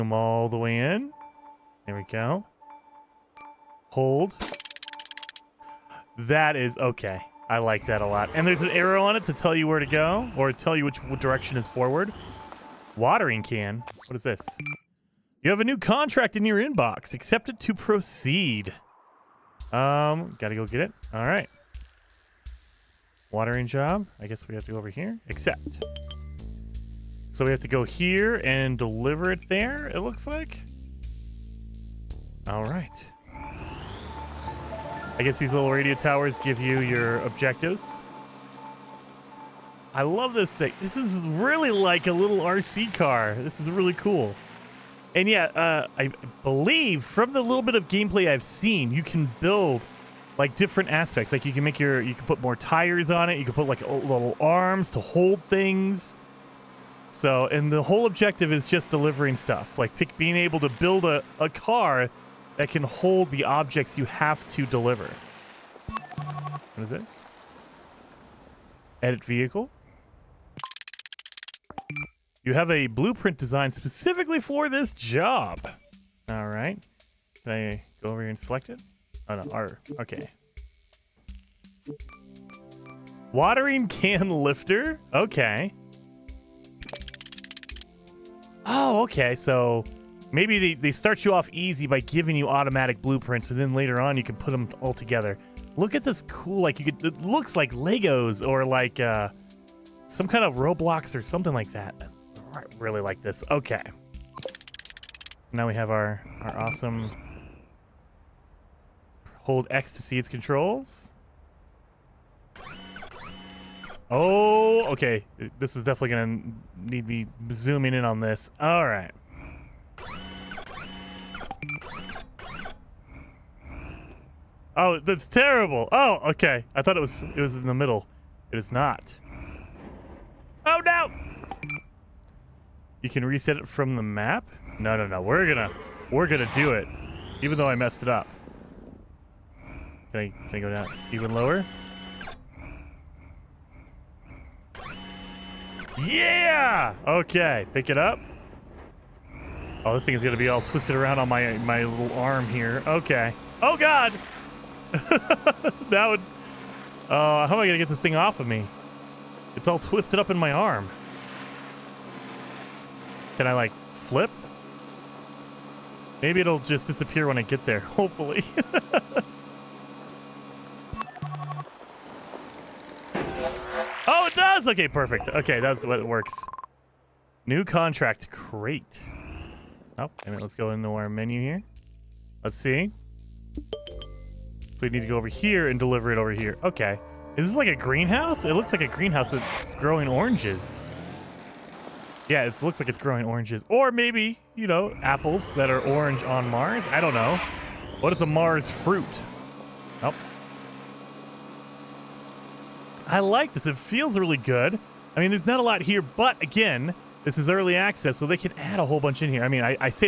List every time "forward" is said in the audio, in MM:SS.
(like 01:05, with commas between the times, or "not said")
00:11.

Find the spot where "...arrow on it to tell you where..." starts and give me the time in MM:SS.
00:08.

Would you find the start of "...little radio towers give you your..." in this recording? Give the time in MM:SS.
00:35.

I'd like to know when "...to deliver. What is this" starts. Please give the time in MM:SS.
01:04.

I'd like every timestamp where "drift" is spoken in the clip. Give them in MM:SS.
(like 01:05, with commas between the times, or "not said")
not said.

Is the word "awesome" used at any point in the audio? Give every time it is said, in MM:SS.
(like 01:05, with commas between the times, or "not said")
01:46.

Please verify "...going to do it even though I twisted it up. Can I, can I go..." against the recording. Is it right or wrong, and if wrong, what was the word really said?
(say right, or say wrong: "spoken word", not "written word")
wrong: "messed", not "twisted".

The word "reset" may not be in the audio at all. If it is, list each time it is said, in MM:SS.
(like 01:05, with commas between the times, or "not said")
02:13.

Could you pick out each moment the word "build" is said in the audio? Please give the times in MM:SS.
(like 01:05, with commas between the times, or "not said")
00:49, 01:00.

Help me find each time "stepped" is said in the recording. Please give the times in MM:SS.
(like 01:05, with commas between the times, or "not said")
not said.